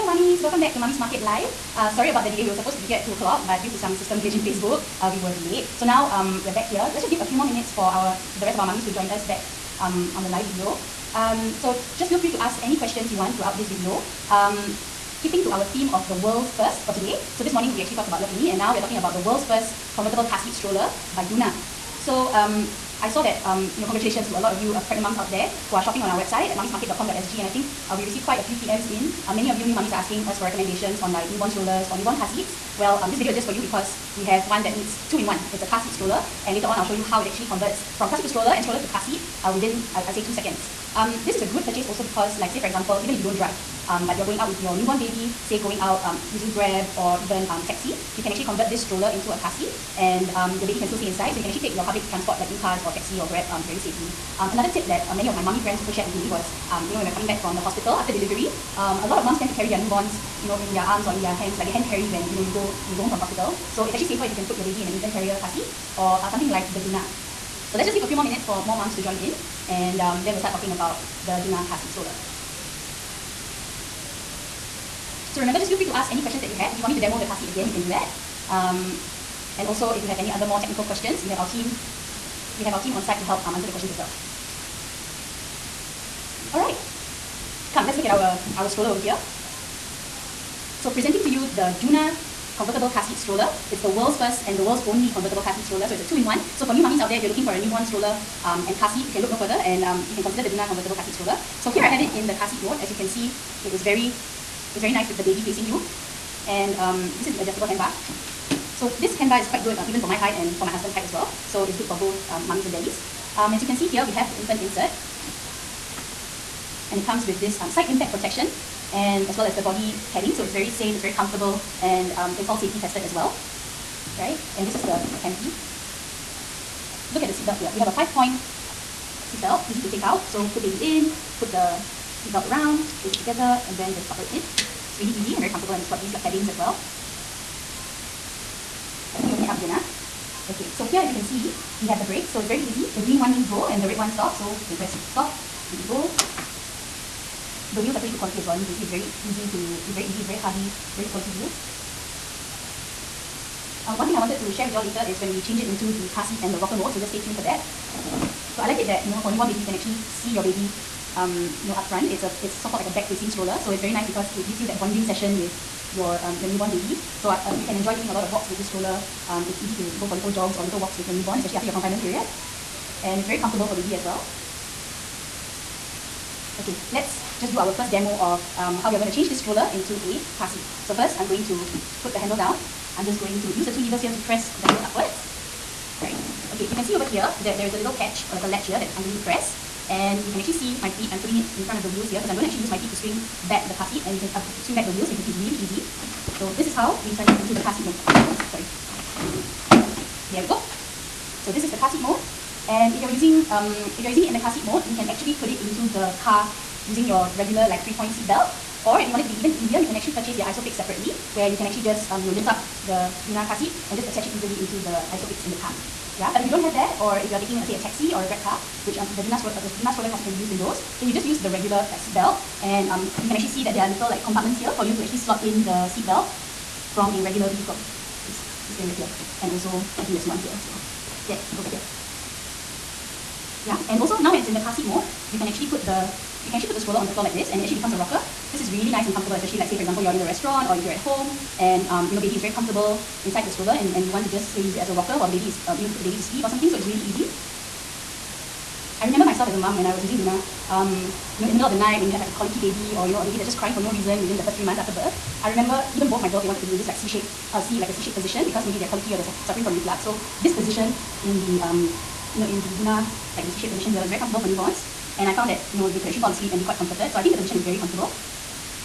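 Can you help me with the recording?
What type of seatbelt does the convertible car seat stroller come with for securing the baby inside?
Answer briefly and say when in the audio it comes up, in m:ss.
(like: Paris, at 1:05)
five-point seatbelt, at 2:07.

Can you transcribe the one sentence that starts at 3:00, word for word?
So first, I'm going to put the handle down.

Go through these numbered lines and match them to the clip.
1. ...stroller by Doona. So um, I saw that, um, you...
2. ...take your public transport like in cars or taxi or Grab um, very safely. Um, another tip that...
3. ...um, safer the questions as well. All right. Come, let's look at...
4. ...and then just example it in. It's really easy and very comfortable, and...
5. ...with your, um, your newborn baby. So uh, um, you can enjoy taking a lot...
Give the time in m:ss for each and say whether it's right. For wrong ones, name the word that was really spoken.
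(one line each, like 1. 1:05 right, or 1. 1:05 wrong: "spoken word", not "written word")
1. 0:20 right
2. 0:51 right
3. 1:23 wrong: "answer", not "safer"
4. 2:13 wrong: "buckle", not "example"
5. 2:45 right.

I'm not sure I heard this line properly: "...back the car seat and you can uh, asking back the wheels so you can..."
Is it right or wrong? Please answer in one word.
wrong.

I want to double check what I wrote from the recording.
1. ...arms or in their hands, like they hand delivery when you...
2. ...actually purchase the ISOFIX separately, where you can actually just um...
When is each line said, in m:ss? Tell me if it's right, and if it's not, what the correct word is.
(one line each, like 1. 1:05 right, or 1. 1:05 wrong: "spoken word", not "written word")
1. 1:00 wrong: "carry", not "delivery"
2. 3:29 right.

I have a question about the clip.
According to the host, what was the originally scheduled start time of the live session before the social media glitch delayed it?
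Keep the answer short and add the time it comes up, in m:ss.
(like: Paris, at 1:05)
2 o'clock, at 0:03.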